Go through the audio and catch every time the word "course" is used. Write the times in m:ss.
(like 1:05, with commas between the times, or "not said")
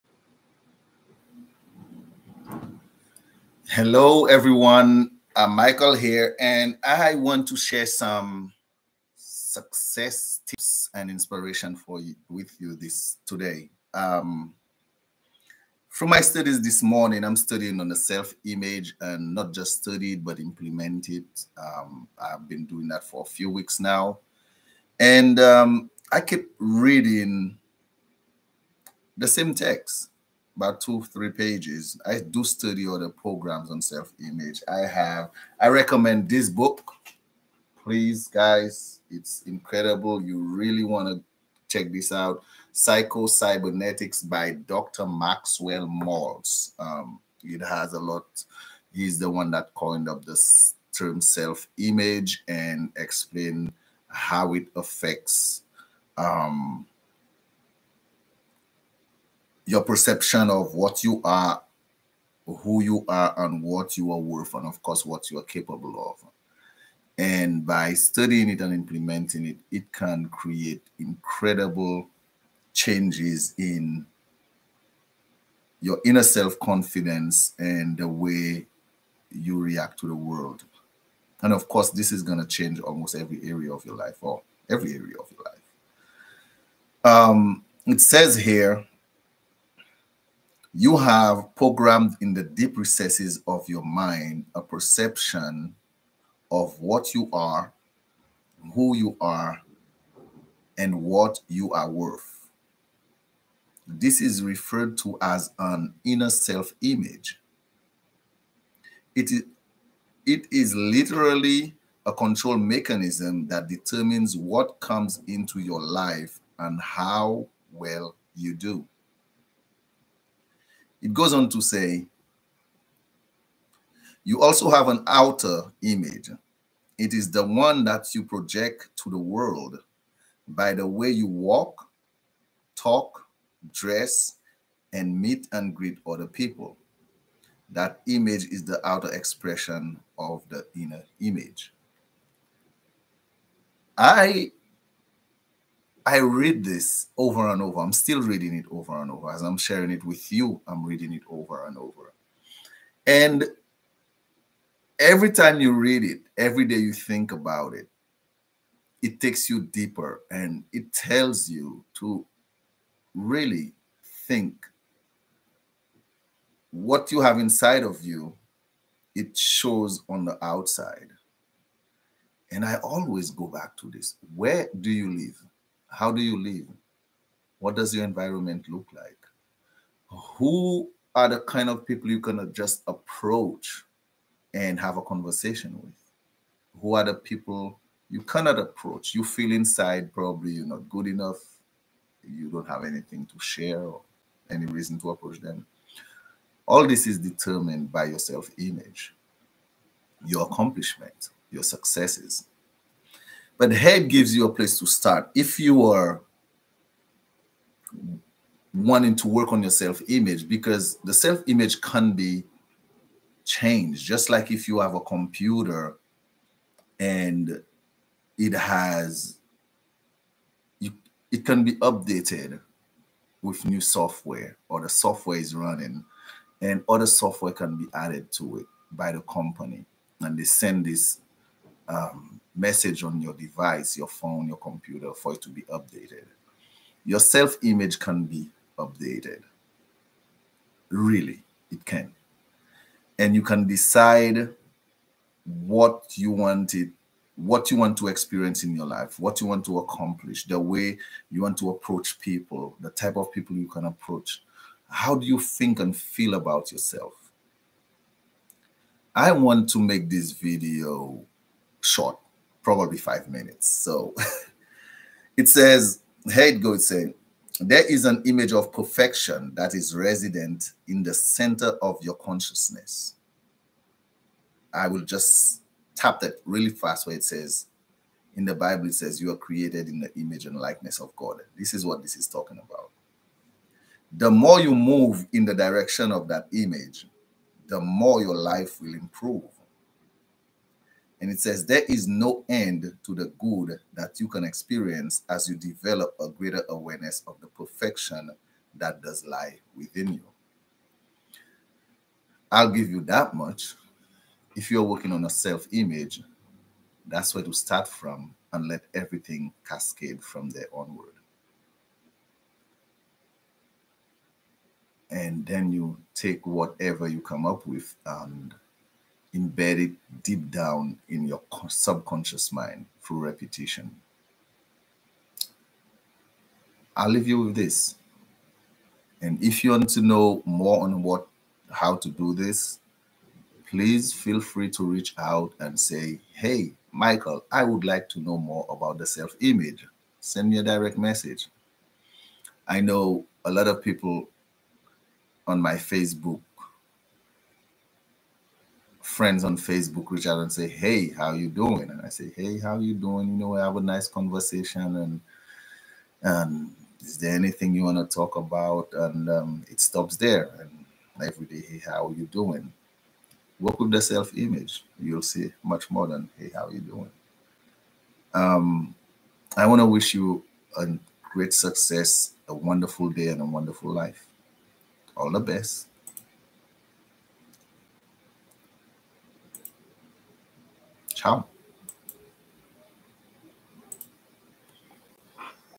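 1:04, 1:21.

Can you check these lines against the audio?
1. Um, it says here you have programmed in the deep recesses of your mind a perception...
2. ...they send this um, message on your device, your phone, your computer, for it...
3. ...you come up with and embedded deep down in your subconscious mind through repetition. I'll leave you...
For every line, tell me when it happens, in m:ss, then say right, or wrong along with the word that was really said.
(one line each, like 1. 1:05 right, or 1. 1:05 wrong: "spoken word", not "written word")
1. 1:27 right
2. 3:50 right
3. 5:17 right.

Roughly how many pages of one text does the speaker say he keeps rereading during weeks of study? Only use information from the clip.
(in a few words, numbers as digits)
2 or 3 pages.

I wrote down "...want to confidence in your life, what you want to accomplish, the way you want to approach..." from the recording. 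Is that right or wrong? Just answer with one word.
wrong.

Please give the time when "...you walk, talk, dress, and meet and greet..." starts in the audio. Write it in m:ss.
2:11.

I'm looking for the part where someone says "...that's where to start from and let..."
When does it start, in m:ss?
5:07.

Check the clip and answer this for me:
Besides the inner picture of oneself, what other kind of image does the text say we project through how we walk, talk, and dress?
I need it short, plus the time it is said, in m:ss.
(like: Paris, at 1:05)
outer image, at 2:05.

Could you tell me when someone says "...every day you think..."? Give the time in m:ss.
2:36.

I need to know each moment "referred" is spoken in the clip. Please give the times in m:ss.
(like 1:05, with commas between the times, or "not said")
1:44.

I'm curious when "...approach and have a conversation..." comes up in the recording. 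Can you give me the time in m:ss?
3:02.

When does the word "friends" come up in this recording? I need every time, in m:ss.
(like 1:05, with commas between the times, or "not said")
5:49.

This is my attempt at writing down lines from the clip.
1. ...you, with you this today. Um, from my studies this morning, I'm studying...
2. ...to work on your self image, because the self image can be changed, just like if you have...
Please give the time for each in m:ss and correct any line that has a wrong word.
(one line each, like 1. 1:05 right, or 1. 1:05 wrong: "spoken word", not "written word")
1. 0:12 right
2. 3:29 right.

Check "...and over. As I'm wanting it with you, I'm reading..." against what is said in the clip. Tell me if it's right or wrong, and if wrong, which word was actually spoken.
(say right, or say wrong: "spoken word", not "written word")
wrong: "sharing", not "wanting".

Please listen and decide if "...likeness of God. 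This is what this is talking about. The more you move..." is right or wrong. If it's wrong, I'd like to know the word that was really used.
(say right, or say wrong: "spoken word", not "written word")
right.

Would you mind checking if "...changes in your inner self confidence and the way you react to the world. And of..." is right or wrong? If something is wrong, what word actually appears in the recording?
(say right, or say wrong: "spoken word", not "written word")
right.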